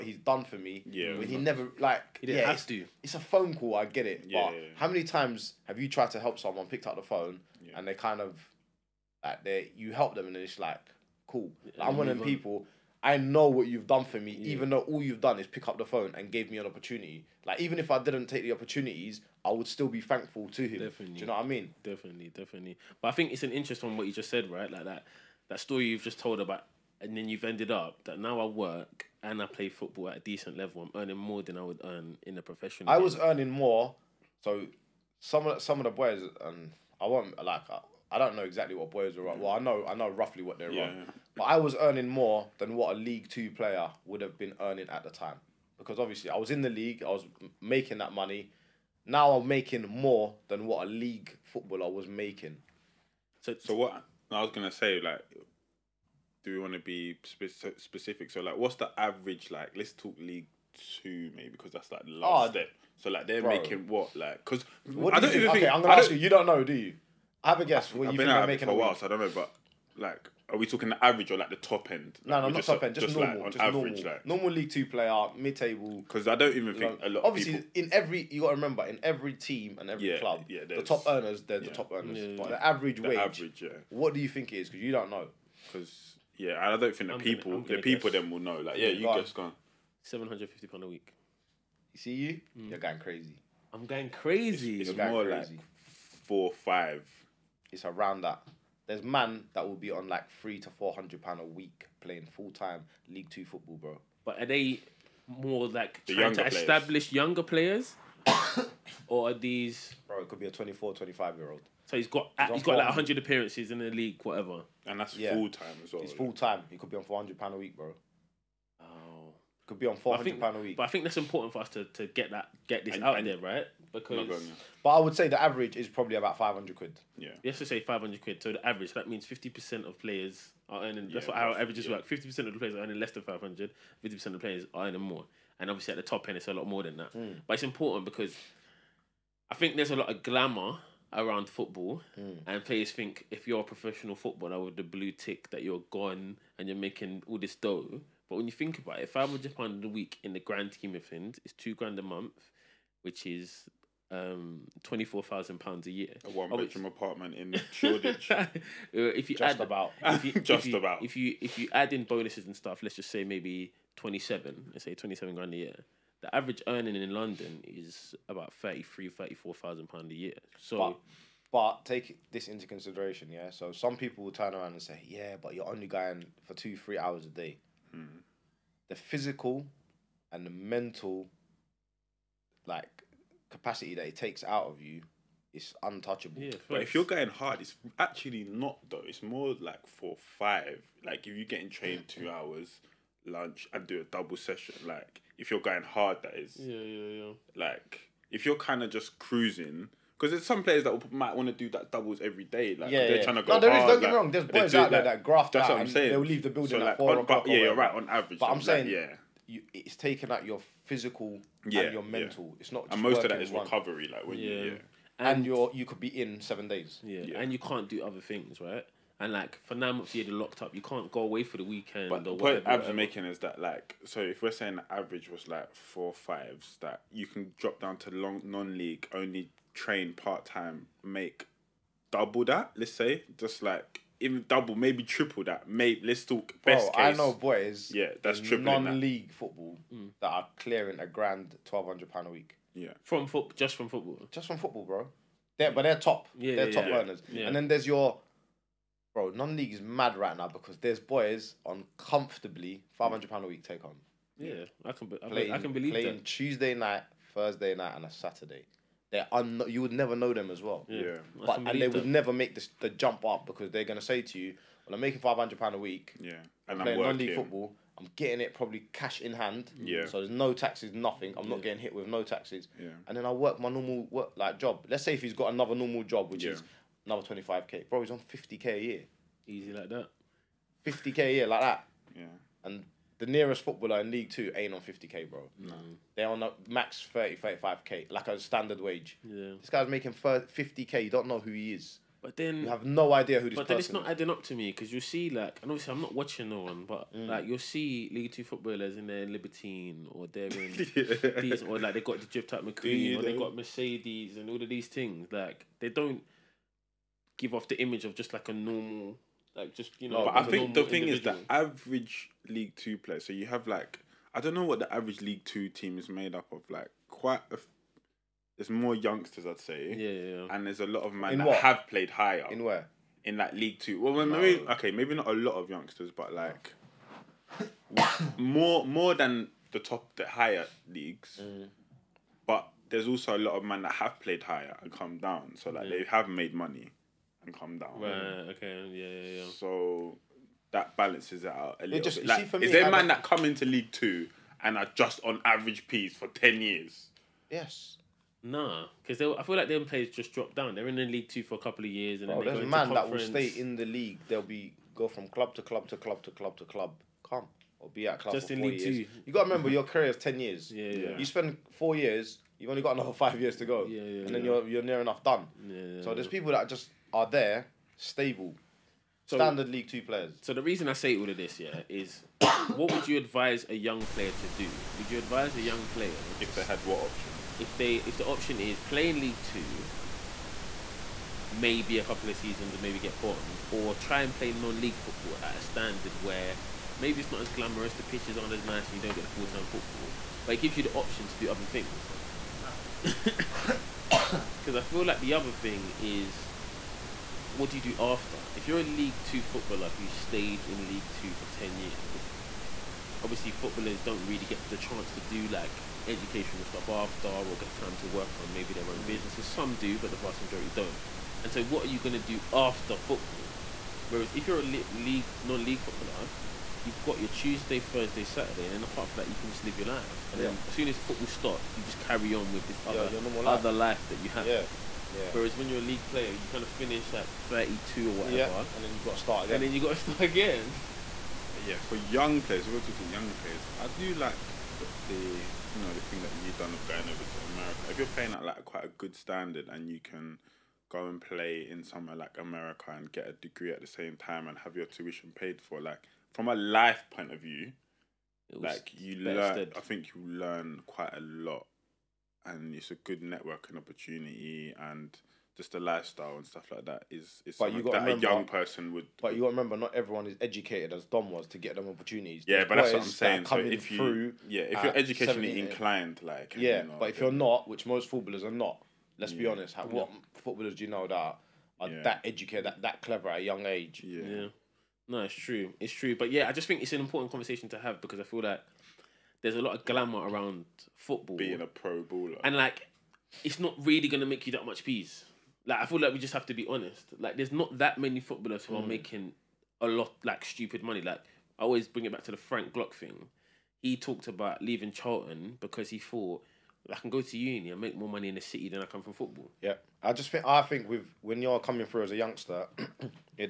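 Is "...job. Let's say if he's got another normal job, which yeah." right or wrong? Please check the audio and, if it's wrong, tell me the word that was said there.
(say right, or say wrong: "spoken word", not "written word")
right.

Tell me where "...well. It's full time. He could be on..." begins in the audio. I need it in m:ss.
1:55.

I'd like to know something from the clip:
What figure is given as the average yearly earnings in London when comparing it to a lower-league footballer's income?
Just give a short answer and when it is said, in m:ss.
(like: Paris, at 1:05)
£33,000-34,000, at 2:48.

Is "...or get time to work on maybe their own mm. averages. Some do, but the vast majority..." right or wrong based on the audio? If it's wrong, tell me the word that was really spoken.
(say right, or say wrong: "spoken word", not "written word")
wrong: "businesses", not "averages".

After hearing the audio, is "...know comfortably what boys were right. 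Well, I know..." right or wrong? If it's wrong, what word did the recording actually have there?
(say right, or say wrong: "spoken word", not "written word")
wrong: "exactly", not "comfortably".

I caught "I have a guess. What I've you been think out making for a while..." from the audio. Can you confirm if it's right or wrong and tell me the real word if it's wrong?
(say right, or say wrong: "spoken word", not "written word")
right.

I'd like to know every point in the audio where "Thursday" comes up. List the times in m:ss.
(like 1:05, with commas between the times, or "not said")
4:17, 6:57.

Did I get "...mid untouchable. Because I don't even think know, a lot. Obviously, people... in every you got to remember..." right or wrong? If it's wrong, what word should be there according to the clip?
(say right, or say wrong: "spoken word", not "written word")
wrong: "table", not "untouchable".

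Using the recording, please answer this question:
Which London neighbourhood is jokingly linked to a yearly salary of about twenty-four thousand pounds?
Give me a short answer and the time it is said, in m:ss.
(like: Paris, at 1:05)
Shoreditch, at 2:37.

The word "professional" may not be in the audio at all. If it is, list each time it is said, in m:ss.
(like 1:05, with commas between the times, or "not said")
0:32, 2:23.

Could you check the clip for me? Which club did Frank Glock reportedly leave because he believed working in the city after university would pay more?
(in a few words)
Charlton.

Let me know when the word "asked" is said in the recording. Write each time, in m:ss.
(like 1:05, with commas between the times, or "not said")
not said.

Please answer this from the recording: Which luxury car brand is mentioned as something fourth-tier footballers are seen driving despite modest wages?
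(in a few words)
Mercedes.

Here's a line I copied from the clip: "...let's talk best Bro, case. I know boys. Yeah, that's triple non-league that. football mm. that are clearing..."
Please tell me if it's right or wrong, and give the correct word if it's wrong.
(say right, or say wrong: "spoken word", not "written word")
right.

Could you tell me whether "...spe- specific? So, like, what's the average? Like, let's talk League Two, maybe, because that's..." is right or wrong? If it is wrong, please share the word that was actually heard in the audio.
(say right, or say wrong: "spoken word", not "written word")
right.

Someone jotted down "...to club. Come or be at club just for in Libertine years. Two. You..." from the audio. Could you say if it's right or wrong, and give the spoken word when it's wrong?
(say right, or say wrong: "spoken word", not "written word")
wrong: "League", not "Libertine".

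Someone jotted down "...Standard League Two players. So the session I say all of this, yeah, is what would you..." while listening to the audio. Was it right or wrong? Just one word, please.
wrong.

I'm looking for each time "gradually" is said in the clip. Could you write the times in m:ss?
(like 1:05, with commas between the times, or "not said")
not said.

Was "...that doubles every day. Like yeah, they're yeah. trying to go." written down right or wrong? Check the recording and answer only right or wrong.
right.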